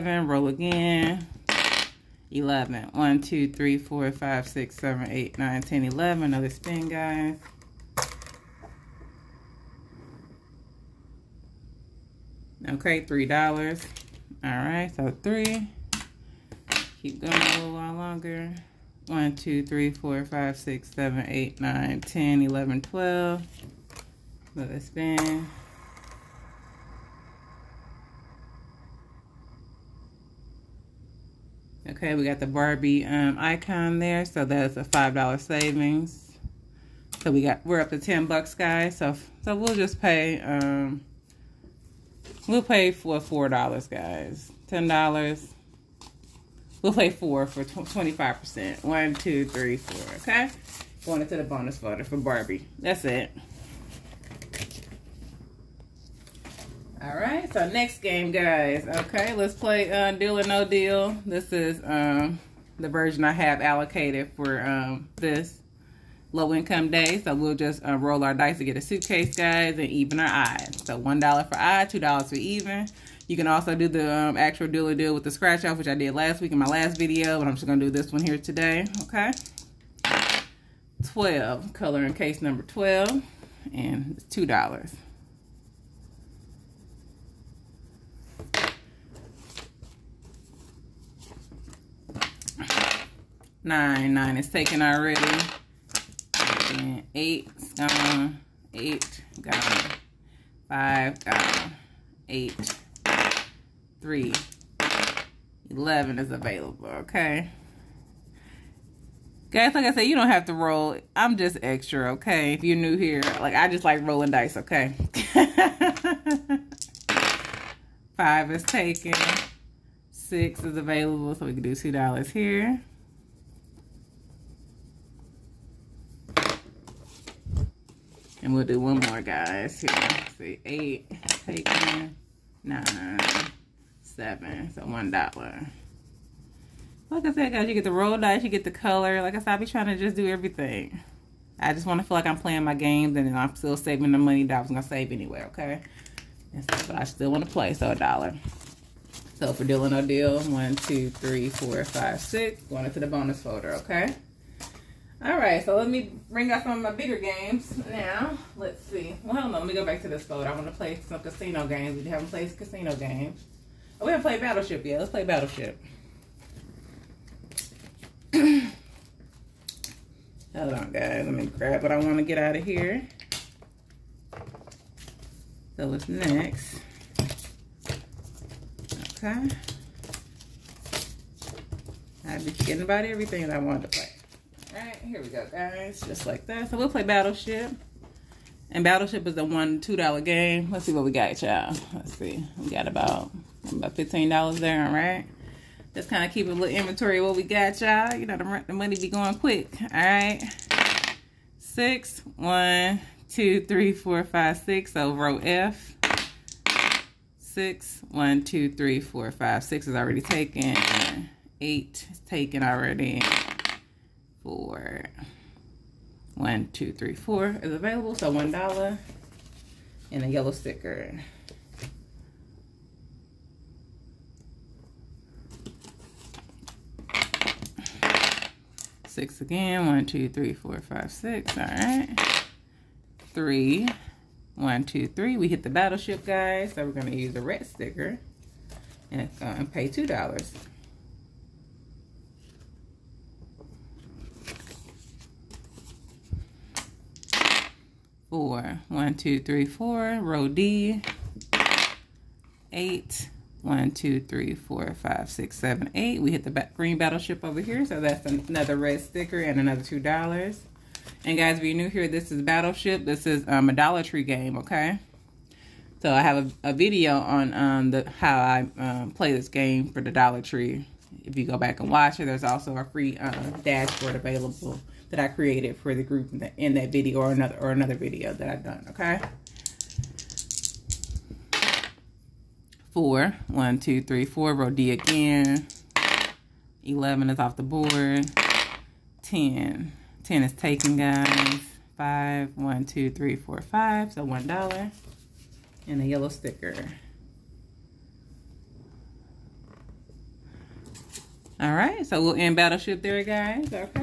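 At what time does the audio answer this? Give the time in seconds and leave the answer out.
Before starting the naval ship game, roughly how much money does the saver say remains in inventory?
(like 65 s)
193 s.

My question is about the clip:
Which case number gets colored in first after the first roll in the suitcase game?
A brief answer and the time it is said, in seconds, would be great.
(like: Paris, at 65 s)
12, at 82 s.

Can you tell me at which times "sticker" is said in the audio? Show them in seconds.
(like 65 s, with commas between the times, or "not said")
220 s, 237 s, 258 s, 296 s.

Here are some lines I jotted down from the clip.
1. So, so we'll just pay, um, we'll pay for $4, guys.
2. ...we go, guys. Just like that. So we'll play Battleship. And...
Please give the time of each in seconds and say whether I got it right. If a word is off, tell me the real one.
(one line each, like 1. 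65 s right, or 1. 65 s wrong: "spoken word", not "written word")
1. 38 s right
2. 185 s right.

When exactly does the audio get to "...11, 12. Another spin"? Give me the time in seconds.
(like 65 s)
22 s.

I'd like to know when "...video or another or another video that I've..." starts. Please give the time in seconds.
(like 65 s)
276 s.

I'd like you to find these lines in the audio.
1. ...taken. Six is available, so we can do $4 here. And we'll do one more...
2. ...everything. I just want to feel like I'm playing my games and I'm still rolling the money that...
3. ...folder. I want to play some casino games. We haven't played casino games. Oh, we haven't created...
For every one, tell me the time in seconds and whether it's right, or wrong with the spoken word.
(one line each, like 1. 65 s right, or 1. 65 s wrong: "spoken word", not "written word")
1. 118 s wrong: "2", not "4"
2. 140 s wrong: "saving", not "rolling"
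3. 160 s wrong: "played", not "created".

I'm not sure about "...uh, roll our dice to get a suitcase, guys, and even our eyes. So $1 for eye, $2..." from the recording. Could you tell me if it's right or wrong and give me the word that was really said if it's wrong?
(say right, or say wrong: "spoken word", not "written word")
right.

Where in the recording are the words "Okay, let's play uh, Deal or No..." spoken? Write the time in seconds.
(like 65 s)
58 s.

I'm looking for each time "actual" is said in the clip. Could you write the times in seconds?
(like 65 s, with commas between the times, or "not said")
74 s.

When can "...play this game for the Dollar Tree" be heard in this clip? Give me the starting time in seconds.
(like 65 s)
269 s.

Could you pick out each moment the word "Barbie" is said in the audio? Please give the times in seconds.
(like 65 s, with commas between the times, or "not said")
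32 s, 52 s.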